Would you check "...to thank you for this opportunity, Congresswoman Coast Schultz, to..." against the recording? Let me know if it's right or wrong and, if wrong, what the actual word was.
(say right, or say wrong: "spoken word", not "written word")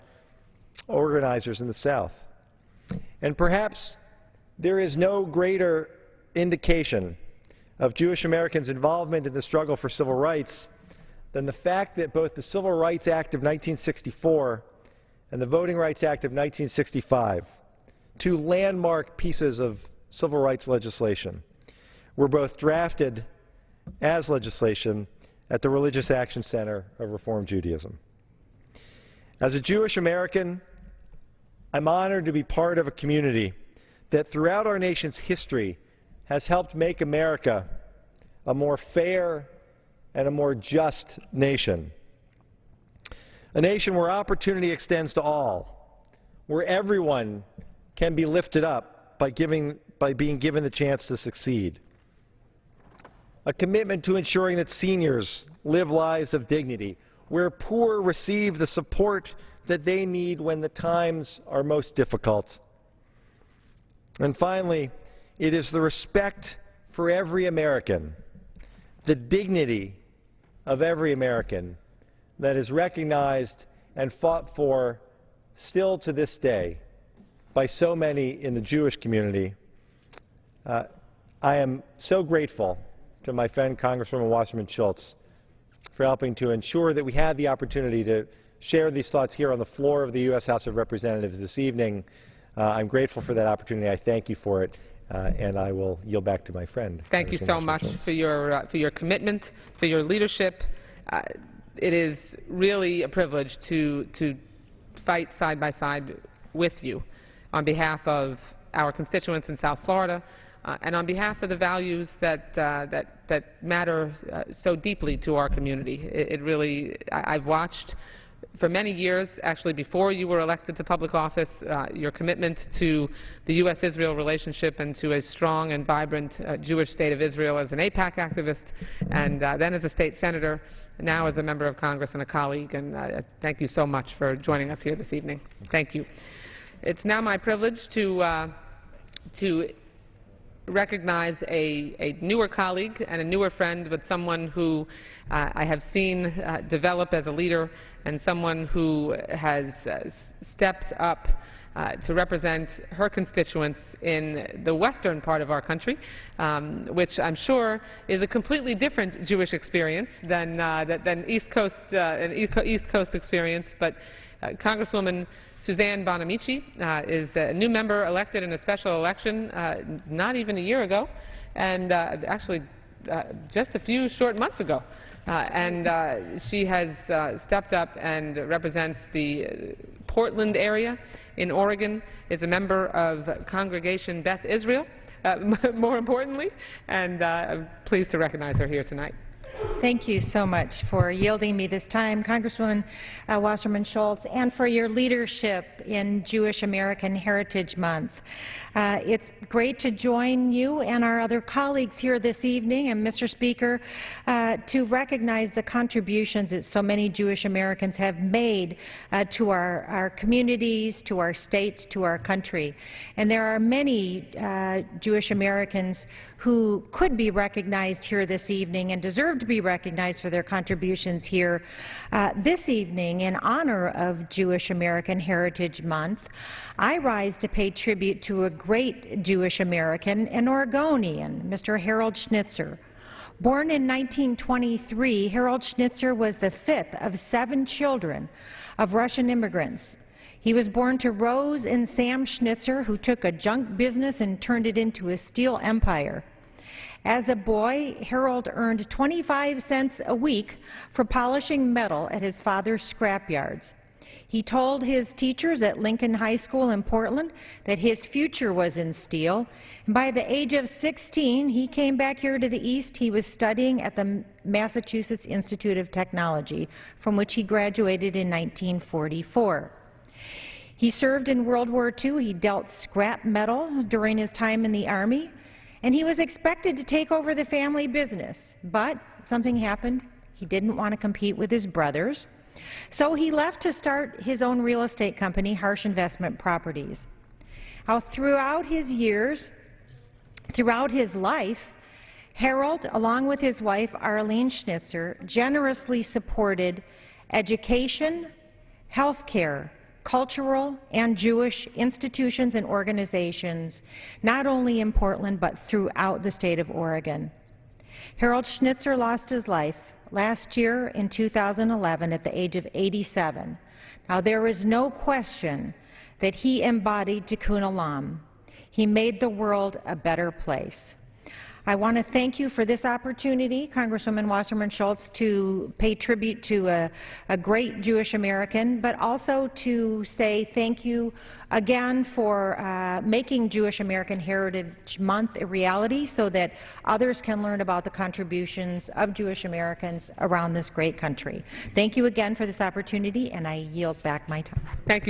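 wrong: "Wasserman", not "Coast".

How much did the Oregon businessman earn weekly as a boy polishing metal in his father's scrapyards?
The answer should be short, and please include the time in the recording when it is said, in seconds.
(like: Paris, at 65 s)
25 cents, at 248 s.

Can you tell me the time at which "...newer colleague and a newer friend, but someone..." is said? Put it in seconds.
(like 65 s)
142 s.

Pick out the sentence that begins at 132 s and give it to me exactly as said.
And thank you so much for joining us here this evening.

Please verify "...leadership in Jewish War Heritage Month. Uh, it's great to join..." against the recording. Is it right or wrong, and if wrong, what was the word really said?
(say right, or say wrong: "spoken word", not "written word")
wrong: "American", not "War".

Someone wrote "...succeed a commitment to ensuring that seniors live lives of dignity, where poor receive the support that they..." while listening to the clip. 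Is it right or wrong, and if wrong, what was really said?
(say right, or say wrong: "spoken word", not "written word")
right.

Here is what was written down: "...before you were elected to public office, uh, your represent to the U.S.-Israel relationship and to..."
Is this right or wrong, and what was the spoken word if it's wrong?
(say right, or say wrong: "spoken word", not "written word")
wrong: "commitment", not "represent".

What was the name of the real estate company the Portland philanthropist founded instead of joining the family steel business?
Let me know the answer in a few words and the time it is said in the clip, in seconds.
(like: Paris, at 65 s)
Harsch Investment Properties, at 285 s.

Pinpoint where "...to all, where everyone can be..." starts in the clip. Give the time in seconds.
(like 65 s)
45 s.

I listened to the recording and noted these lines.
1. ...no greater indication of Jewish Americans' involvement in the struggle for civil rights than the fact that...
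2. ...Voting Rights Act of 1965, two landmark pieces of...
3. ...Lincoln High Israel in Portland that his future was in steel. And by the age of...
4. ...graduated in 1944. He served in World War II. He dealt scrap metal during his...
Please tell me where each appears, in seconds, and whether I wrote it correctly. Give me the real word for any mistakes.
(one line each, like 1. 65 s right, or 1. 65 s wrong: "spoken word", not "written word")
1. 4 s right
2. 15 s right
3. 255 s wrong: "School", not "Israel"
4. 267 s right.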